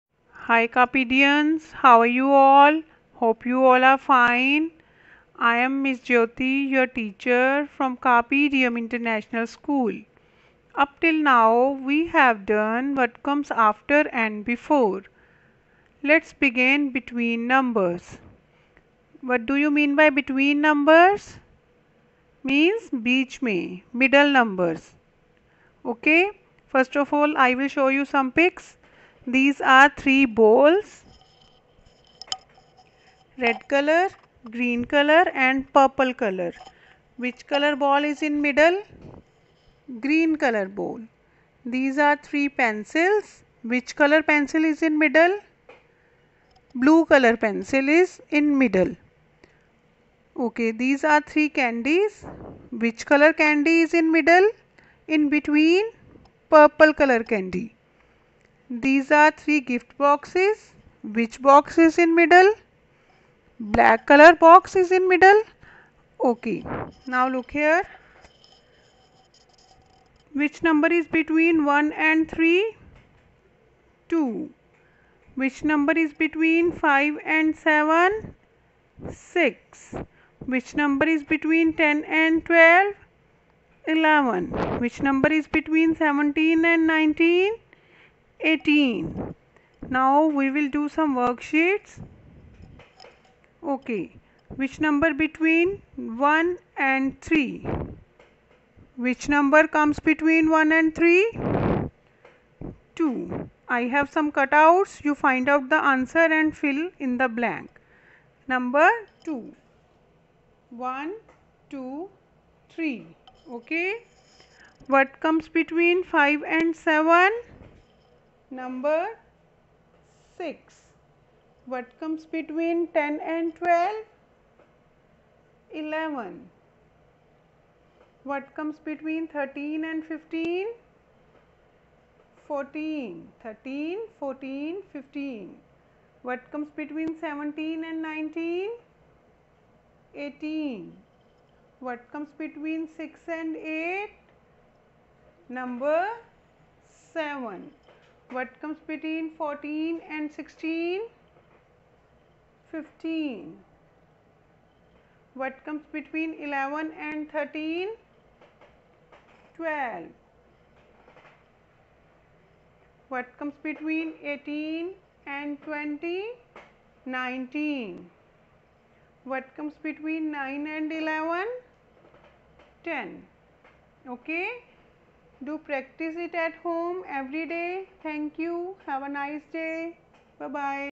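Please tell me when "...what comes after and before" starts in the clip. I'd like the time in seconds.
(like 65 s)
12 s.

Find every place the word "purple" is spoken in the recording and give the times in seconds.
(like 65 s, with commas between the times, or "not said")
35 s, 56 s.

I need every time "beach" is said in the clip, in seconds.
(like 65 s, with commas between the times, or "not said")
22 s.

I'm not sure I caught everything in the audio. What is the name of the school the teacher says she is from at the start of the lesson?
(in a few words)
Carpe Diem International School.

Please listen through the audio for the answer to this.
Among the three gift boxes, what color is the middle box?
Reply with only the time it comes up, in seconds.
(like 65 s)
63 s.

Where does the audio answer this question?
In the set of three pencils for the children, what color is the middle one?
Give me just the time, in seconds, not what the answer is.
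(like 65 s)
46 s.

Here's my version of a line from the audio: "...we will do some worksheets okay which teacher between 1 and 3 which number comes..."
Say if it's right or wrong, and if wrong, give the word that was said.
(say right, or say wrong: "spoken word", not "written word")
wrong: "number", not "teacher".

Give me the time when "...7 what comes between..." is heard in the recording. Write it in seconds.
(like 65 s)
147 s.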